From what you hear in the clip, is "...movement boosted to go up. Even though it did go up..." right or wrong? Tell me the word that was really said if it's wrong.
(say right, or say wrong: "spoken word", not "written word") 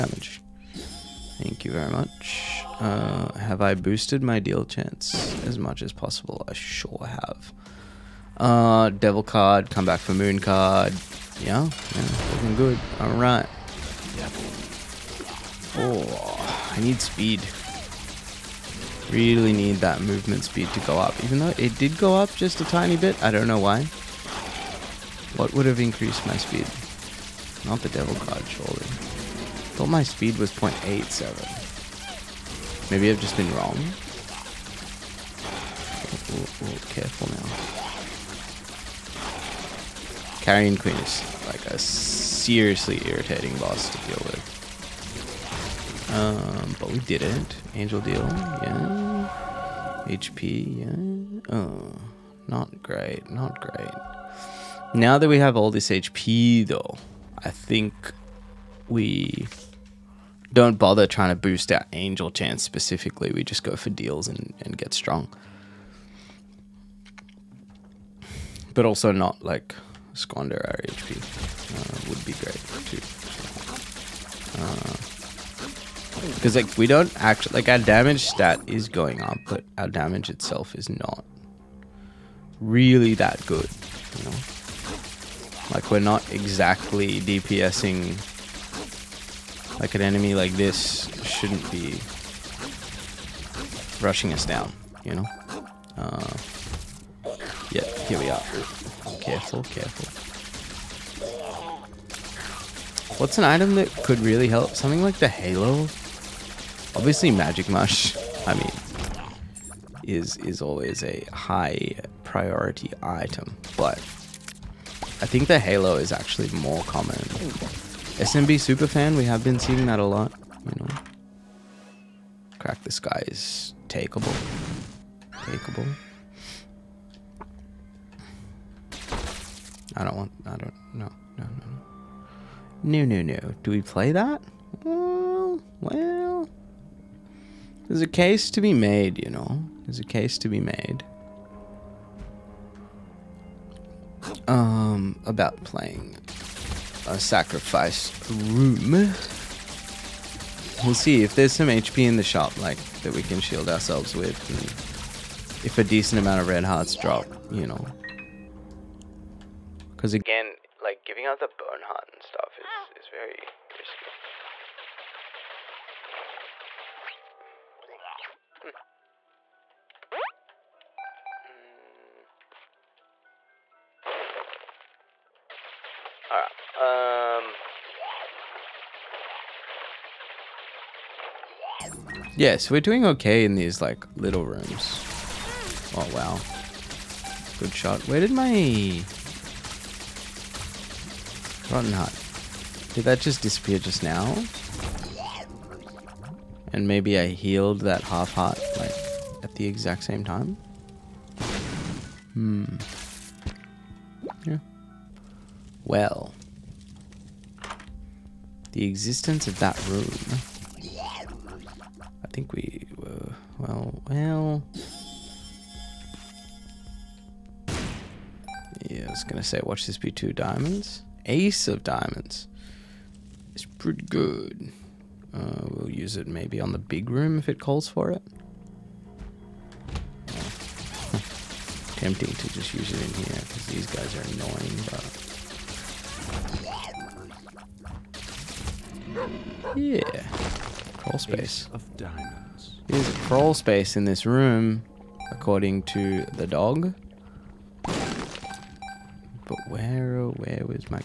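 wrong: "speed", not "boosted".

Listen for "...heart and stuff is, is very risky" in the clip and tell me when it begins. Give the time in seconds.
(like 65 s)
161 s.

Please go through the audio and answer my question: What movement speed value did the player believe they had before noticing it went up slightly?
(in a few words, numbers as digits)
0.87.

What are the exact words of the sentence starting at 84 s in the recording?
You know, like we're not exactly DPSing.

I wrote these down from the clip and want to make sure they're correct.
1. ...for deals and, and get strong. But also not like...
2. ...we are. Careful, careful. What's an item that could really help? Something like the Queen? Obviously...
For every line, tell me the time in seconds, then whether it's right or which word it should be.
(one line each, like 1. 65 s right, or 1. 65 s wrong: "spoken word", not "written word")
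1. 63 s right
2. 98 s wrong: "Halo", not "Queen".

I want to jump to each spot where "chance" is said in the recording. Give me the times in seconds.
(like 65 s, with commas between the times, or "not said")
4 s, 62 s.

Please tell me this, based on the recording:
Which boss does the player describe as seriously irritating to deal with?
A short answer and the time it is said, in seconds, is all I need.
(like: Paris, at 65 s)
Carrion Queen, at 40 s.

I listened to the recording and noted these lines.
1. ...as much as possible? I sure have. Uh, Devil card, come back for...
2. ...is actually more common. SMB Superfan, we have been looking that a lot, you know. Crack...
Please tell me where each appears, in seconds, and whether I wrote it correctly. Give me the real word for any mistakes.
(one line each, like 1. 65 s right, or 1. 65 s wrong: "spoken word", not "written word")
1. 5 s right
2. 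115 s wrong: "seeing", not "looking".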